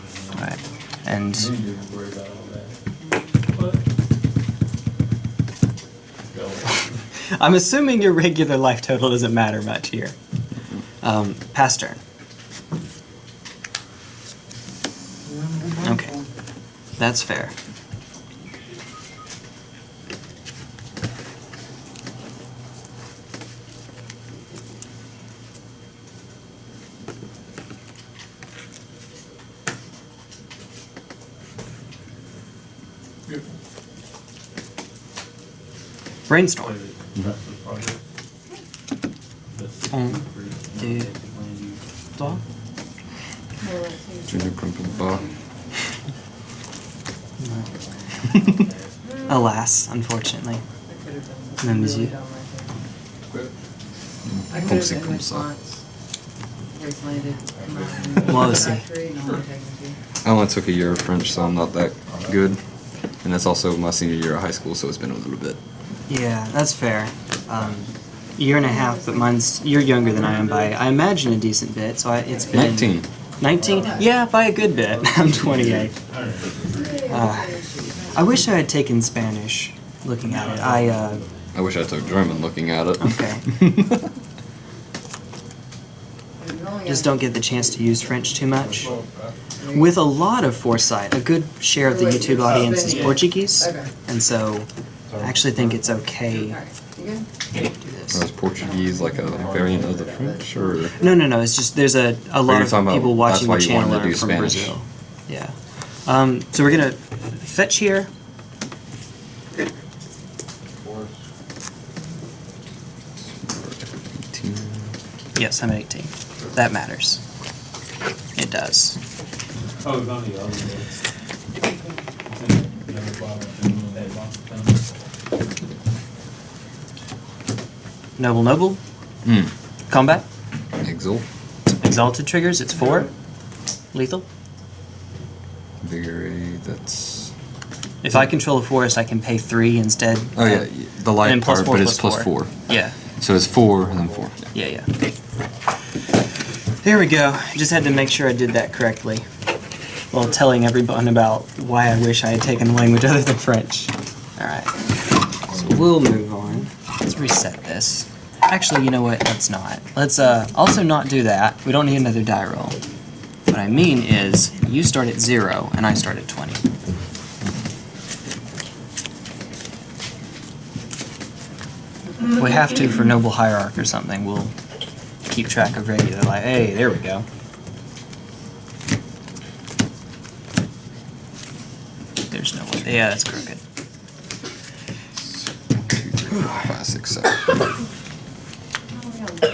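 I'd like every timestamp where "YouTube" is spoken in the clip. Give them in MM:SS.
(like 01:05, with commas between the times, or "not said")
01:32.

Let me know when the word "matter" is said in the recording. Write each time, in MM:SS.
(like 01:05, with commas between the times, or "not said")
00:09, 01:56.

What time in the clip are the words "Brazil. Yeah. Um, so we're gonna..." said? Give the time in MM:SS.
01:44.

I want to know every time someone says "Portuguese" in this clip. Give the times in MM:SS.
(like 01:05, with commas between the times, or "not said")
01:32, 01:38.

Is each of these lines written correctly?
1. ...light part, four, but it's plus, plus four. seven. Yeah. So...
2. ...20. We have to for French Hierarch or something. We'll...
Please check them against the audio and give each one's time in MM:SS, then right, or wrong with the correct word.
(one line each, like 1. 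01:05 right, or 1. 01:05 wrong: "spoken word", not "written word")
1. 02:21 wrong: "four", not "seven"
2. 02:46 wrong: "Noble", not "French".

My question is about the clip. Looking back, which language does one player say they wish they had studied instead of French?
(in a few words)
German.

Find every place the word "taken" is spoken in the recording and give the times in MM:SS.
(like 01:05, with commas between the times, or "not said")
01:18, 02:32.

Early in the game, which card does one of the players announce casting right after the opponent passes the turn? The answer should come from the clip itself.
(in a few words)
Brainstorm.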